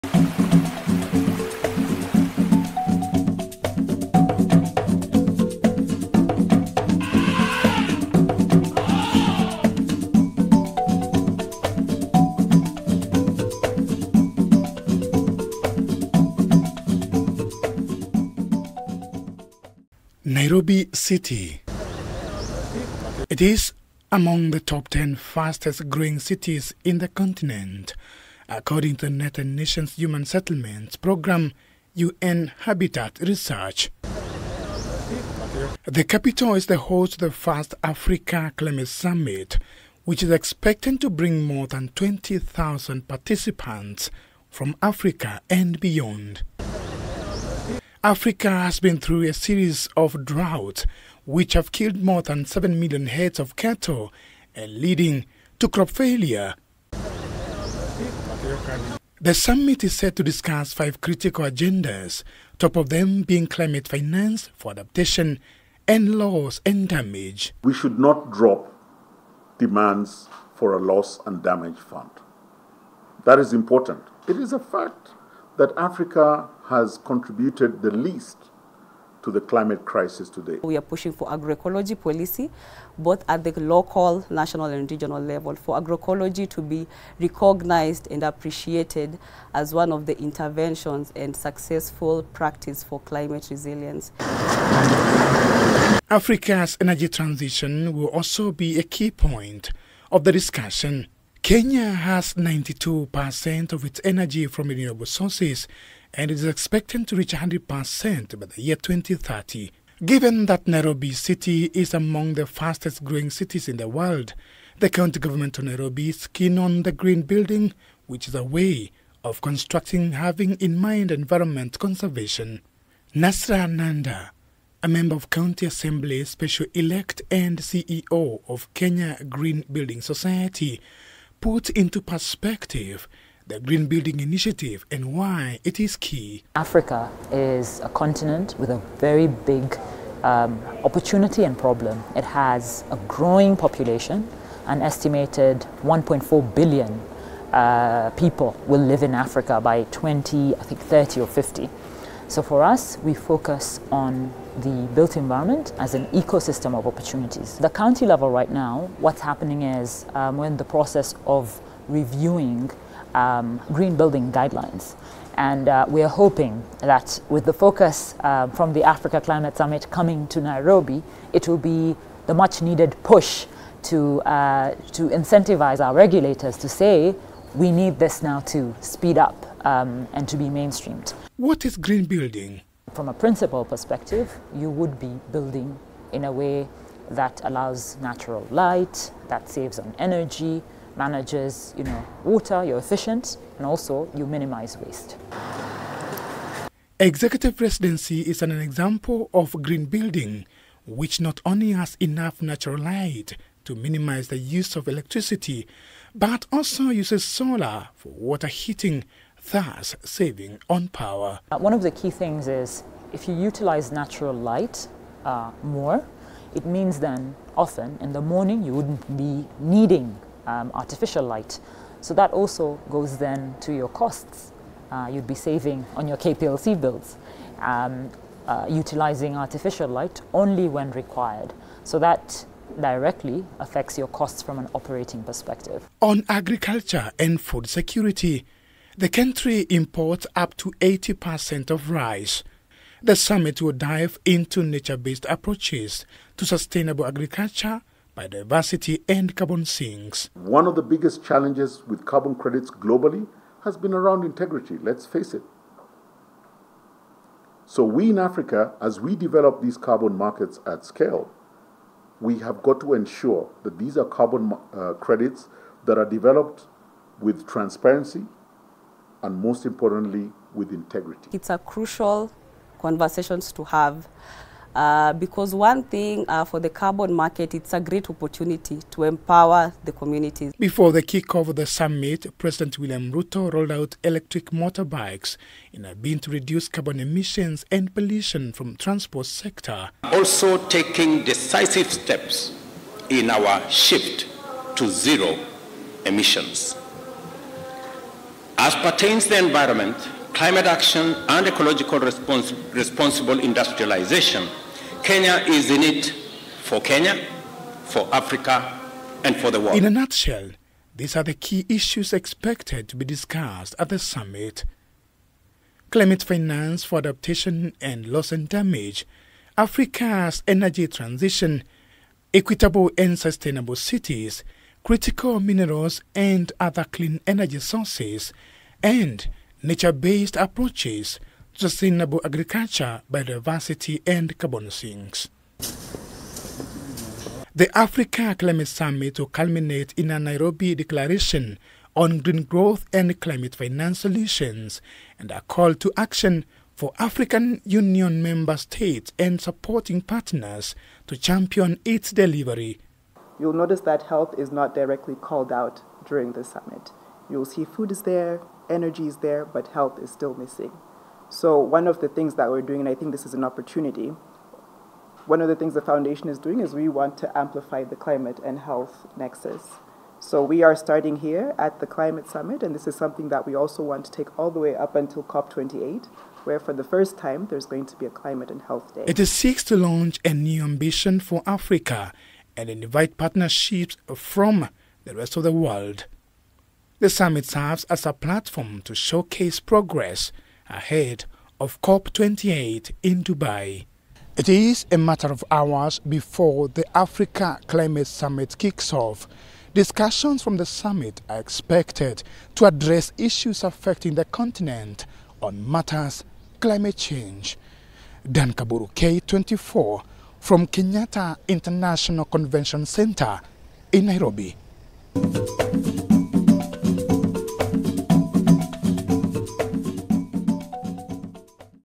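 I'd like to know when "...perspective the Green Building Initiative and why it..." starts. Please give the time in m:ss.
2:11.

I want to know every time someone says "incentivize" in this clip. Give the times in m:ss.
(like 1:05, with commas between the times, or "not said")
2:55.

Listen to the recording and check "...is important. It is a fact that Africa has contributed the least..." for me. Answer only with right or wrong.
right.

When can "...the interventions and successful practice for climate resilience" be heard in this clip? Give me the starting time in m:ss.
1:30.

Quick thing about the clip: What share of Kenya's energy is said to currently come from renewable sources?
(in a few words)
92%.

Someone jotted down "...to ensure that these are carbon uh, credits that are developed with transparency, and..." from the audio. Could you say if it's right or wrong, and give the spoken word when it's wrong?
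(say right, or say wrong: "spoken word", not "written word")
right.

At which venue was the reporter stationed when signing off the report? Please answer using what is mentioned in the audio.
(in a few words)
Kenyatta International Convention Center.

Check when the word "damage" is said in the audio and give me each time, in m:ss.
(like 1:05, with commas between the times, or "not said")
1:06, 1:11, 5:18.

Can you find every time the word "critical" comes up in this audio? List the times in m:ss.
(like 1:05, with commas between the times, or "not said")
1:00, 5:24.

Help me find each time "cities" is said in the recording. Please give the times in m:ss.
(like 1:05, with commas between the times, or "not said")
0:26, 1:53, 5:23.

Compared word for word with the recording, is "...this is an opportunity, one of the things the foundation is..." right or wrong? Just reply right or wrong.
right.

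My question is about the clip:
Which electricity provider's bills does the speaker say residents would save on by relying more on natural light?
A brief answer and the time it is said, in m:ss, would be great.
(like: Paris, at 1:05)
KPLC, at 3:46.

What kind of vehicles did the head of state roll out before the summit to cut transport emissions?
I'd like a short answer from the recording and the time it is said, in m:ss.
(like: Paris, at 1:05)
electric motorbikes, at 4:44.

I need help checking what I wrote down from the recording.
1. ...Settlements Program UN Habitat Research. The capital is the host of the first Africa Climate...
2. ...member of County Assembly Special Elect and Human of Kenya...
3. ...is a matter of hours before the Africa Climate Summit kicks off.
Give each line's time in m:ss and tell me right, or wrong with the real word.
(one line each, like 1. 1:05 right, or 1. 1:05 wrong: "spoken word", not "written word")
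1. 0:30 right
2. 2:04 wrong: "CEO", not "Human"
3. 6:34 right.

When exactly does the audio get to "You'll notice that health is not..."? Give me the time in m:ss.
5:53.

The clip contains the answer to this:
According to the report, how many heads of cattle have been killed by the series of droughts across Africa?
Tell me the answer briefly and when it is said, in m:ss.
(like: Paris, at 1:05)
more than 7 million, at 0:52.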